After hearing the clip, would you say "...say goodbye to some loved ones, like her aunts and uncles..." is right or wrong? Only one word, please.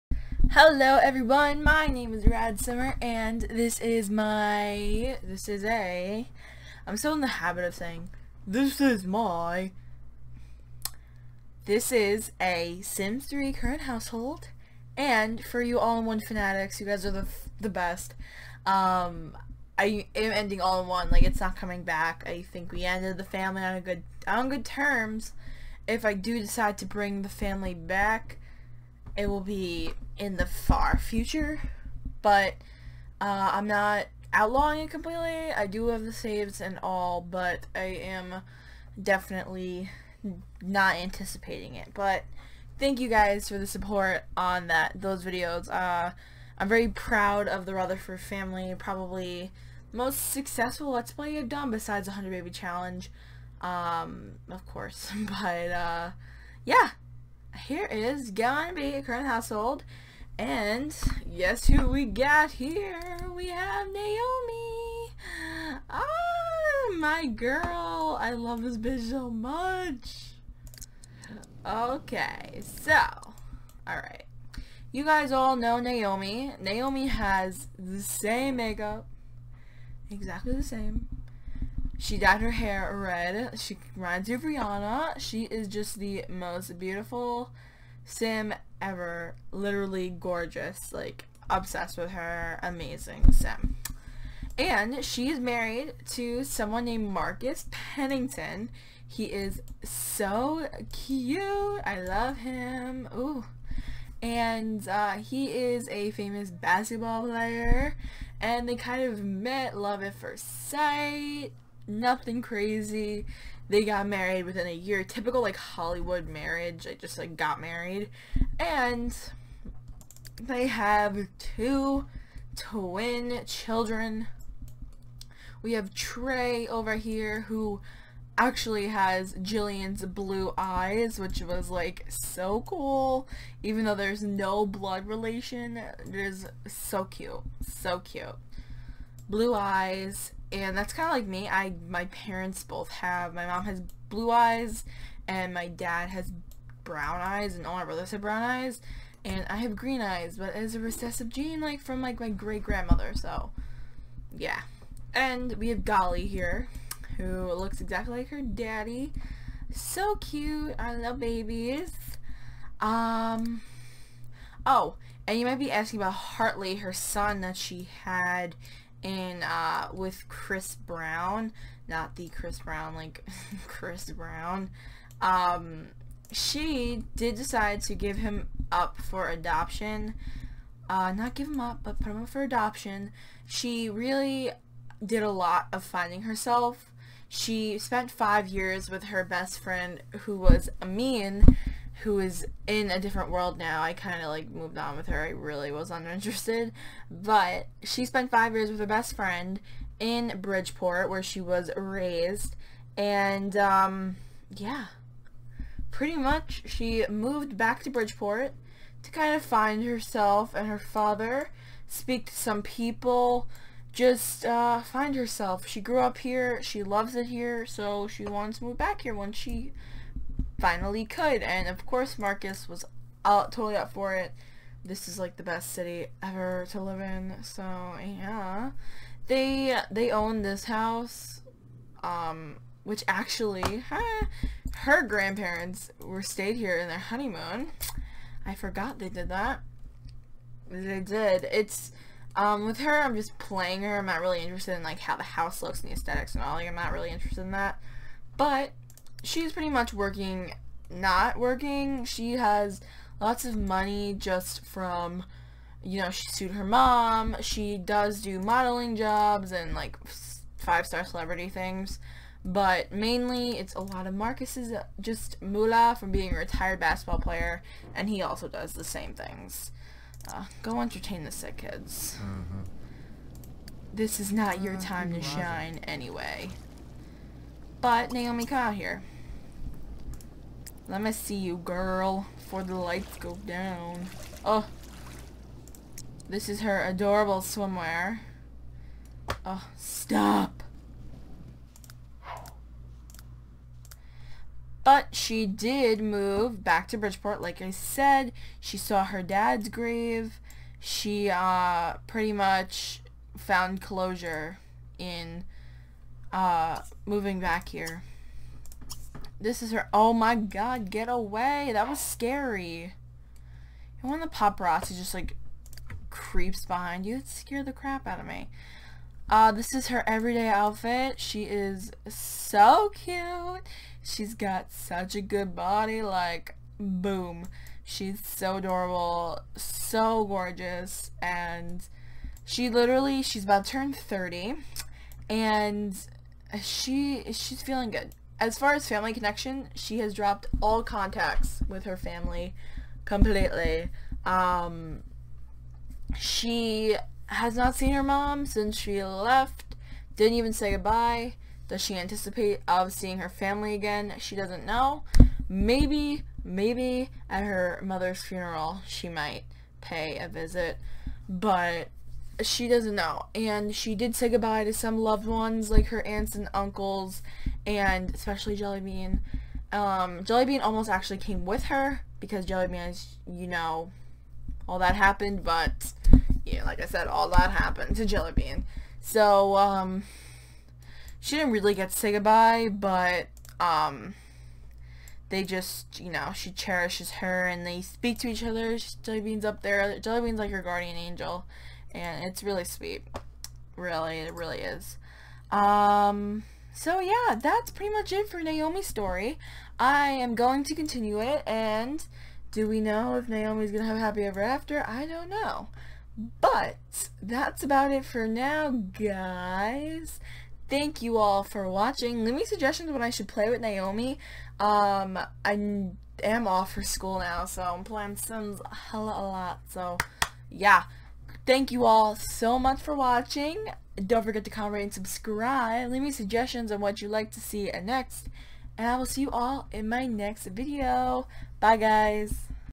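right.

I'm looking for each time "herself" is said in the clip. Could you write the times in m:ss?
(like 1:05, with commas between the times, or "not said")
3:06, 3:29, 3:35.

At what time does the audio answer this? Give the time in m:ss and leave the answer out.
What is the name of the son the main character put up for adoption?
2:46.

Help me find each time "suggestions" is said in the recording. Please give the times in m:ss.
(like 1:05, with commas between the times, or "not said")
6:52, 7:06.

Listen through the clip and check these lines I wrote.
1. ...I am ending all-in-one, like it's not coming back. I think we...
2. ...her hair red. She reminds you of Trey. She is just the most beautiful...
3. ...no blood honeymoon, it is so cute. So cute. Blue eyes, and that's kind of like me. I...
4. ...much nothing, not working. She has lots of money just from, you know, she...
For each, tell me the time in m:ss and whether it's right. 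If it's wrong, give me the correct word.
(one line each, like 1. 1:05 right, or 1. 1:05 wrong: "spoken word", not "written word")
1. 0:19 right
2. 1:22 wrong: "Rihanna", not "Trey"
3. 2:14 wrong: "relation", not "honeymoon"
4. 4:09 wrong: "working", not "nothing".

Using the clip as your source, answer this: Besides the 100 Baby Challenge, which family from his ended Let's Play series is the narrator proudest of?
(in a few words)
Rutherford.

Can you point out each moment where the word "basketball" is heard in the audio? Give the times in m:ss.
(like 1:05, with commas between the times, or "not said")
1:46, 4:26.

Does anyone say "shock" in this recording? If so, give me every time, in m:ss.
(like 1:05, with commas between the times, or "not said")
not said.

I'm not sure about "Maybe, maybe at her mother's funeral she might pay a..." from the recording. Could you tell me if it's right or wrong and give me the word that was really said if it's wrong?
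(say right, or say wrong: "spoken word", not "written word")
right.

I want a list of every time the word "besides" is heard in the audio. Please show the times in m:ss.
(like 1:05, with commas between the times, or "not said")
0:51.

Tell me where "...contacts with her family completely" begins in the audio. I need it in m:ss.
5:40.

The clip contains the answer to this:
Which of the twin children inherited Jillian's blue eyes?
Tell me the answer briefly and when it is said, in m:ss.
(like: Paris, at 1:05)
Trey, at 2:05.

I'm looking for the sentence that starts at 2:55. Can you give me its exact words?
Um, she did decide to give him up for adoption.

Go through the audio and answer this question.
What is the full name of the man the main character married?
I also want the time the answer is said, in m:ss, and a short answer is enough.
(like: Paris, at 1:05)
Marcus Pennington, at 1:37.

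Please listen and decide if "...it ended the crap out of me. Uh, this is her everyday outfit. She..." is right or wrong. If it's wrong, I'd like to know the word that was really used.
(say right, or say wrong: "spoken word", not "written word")
wrong: "scared", not "ended".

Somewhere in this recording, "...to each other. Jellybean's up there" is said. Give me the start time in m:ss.
6:28.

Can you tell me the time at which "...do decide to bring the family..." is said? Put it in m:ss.
0:26.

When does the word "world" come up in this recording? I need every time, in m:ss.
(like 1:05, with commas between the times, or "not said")
3:13.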